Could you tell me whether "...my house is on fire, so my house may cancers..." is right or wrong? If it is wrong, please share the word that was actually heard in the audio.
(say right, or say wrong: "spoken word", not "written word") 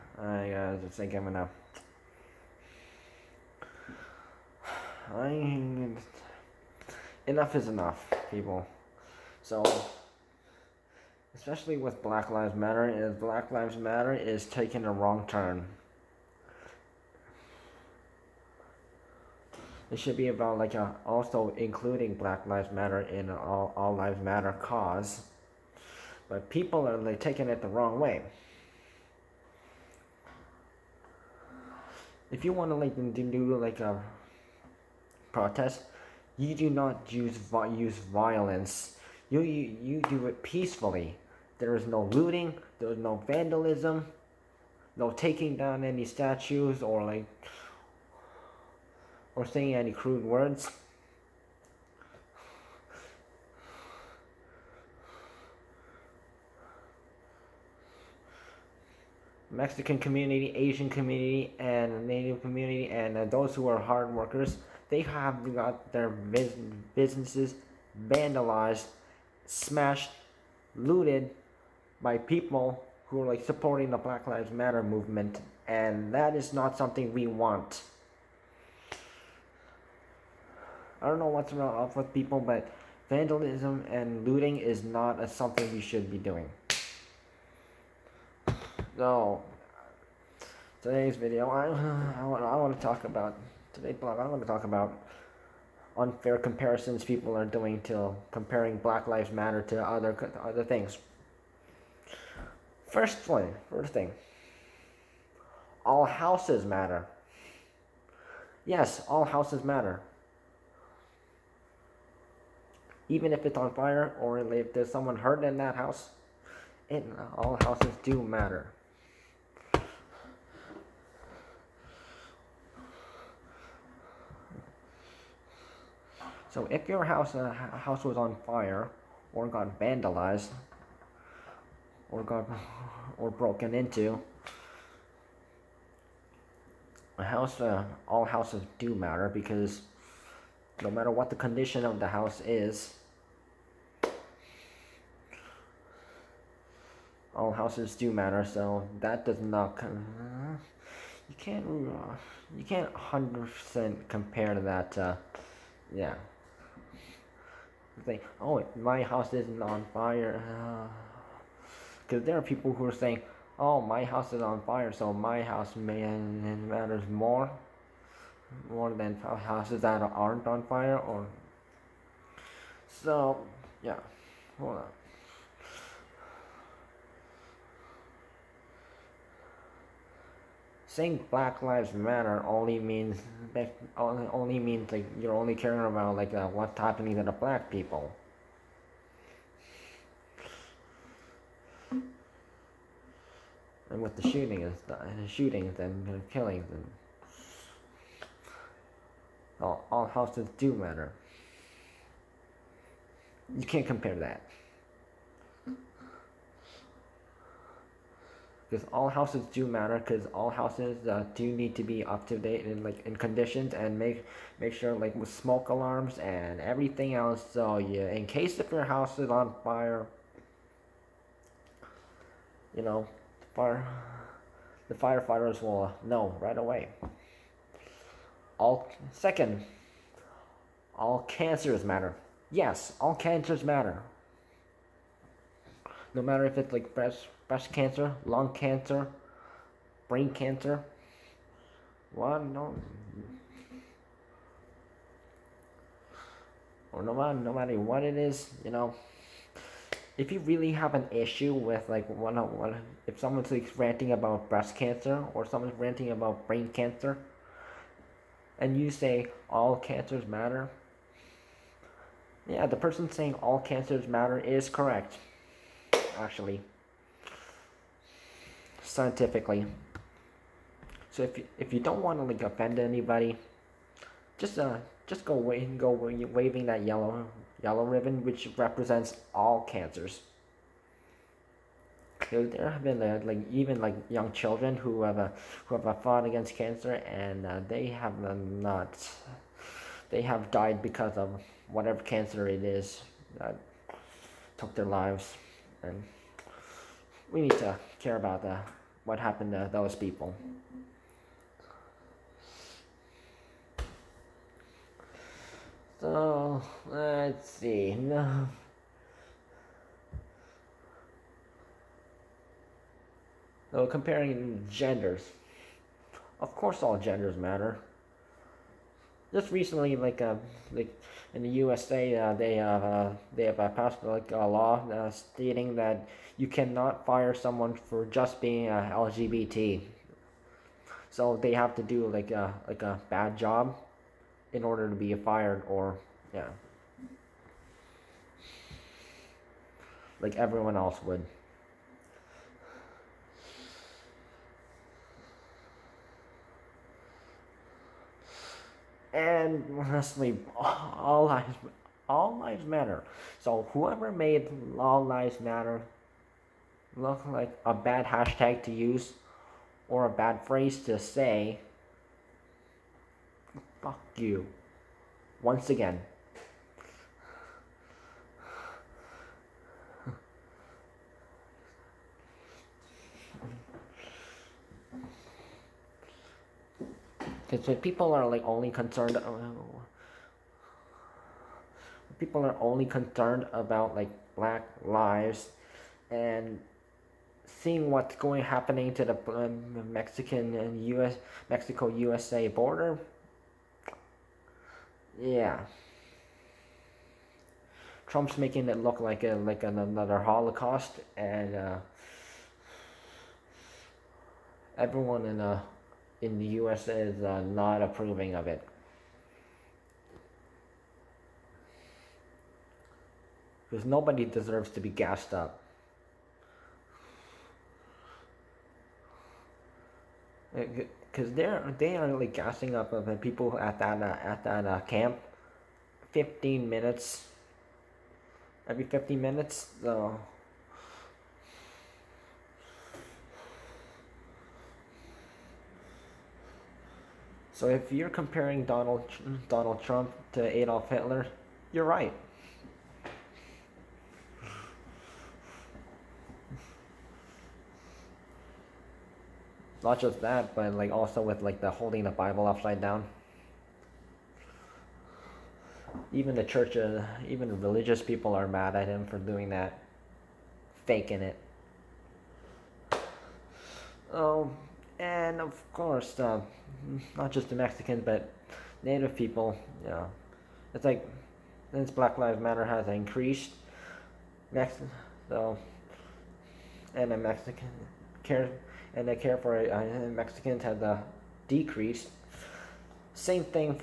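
wrong: "matters", not "cancers".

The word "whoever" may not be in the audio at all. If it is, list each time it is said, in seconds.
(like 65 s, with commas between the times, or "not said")
353 s.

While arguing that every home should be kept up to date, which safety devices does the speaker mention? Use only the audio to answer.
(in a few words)
smoke alarms.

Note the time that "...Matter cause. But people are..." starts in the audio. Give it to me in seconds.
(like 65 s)
24 s.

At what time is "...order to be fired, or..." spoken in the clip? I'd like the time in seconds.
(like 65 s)
334 s.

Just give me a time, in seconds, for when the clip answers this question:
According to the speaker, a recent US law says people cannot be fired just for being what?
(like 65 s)
328 s.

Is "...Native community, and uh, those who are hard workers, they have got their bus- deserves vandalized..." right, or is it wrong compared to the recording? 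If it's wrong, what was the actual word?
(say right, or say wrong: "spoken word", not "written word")
wrong: "businesses", not "deserves".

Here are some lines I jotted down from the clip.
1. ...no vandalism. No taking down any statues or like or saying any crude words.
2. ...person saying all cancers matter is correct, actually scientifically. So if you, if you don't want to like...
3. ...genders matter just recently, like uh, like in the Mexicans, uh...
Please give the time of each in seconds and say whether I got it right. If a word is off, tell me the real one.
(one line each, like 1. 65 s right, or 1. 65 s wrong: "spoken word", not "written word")
1. 43 s right
2. 262 s right
3. 316 s wrong: "USA", not "Mexicans".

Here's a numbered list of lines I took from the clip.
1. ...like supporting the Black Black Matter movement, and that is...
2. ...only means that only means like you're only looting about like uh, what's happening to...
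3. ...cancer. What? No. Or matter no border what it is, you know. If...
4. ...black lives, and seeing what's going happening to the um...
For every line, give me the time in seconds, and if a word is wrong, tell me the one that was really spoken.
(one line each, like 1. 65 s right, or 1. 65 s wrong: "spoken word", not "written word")
1. 73 s wrong: "Lives", not "Black"
2. 182 s wrong: "caring", not "looting"
3. 240 s wrong: "matter", not "border"
4. 384 s right.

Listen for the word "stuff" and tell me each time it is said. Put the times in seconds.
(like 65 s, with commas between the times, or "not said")
194 s.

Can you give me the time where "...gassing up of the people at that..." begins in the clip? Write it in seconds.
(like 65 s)
422 s.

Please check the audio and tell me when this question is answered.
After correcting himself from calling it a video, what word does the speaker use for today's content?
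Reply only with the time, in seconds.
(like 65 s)
93 s.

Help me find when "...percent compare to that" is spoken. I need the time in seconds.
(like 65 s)
153 s.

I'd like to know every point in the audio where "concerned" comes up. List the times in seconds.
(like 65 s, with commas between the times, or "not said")
378 s, 382 s.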